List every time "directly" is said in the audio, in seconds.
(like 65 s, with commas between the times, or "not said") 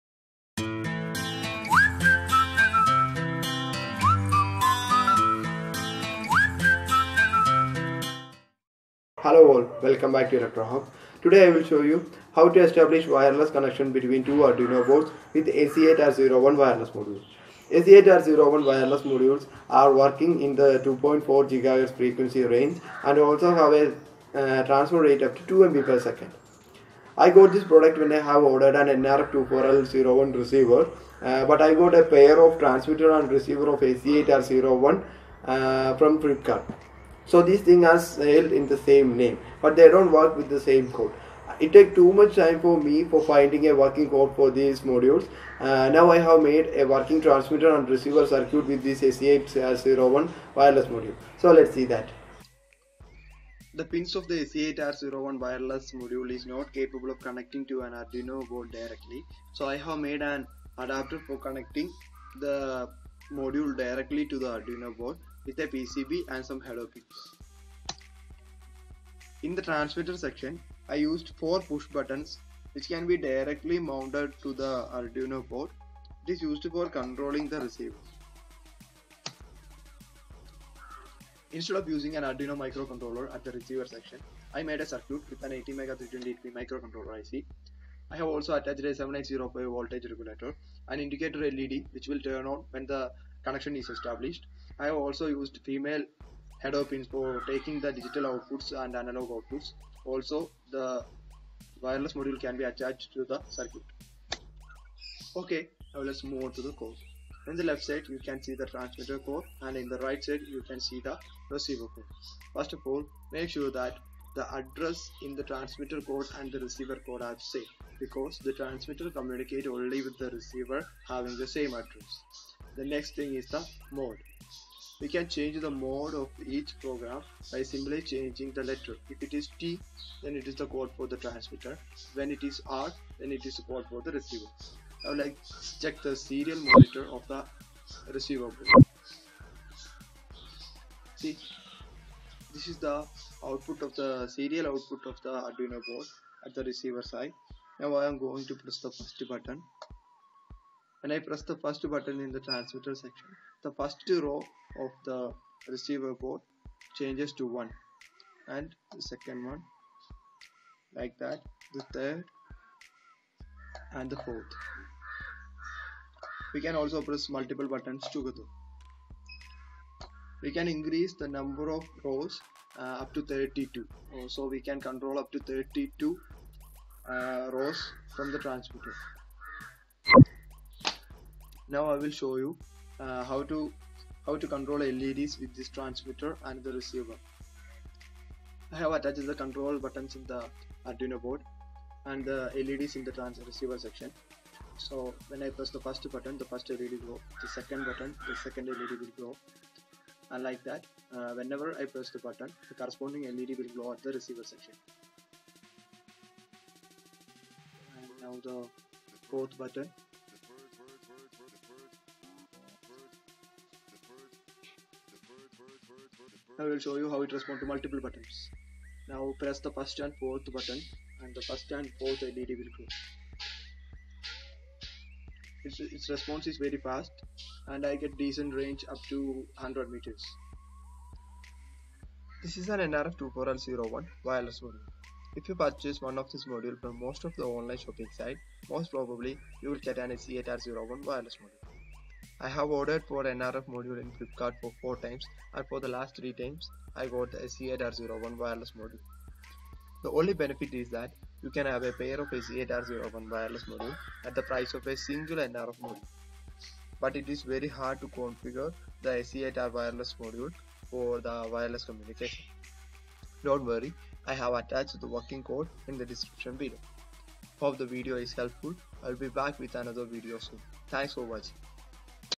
58 s, 63 s, 73 s.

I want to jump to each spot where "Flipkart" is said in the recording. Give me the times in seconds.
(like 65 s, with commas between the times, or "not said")
36 s, 244 s.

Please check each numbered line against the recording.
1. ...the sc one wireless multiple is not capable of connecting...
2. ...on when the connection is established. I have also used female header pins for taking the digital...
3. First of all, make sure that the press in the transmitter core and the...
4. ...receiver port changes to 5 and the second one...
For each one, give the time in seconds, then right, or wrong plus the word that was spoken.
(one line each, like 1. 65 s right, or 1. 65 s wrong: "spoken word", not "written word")
1. 54 s wrong: "module", not "multiple"
2. 92 s right
3. 112 s wrong: "address", not "press"
4. 155 s wrong: "1", not "5".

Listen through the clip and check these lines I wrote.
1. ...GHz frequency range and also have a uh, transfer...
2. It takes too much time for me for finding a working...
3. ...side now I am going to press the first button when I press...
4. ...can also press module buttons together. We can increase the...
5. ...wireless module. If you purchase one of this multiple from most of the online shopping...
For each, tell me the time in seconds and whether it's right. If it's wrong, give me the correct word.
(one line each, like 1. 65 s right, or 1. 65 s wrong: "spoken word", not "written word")
1. 21 s right
2. 41 s right
3. 147 s right
4. 166 s wrong: "multiple", not "module"
5. 234 s wrong: "module", not "multiple".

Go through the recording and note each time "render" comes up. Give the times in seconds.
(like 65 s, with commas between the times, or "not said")
not said.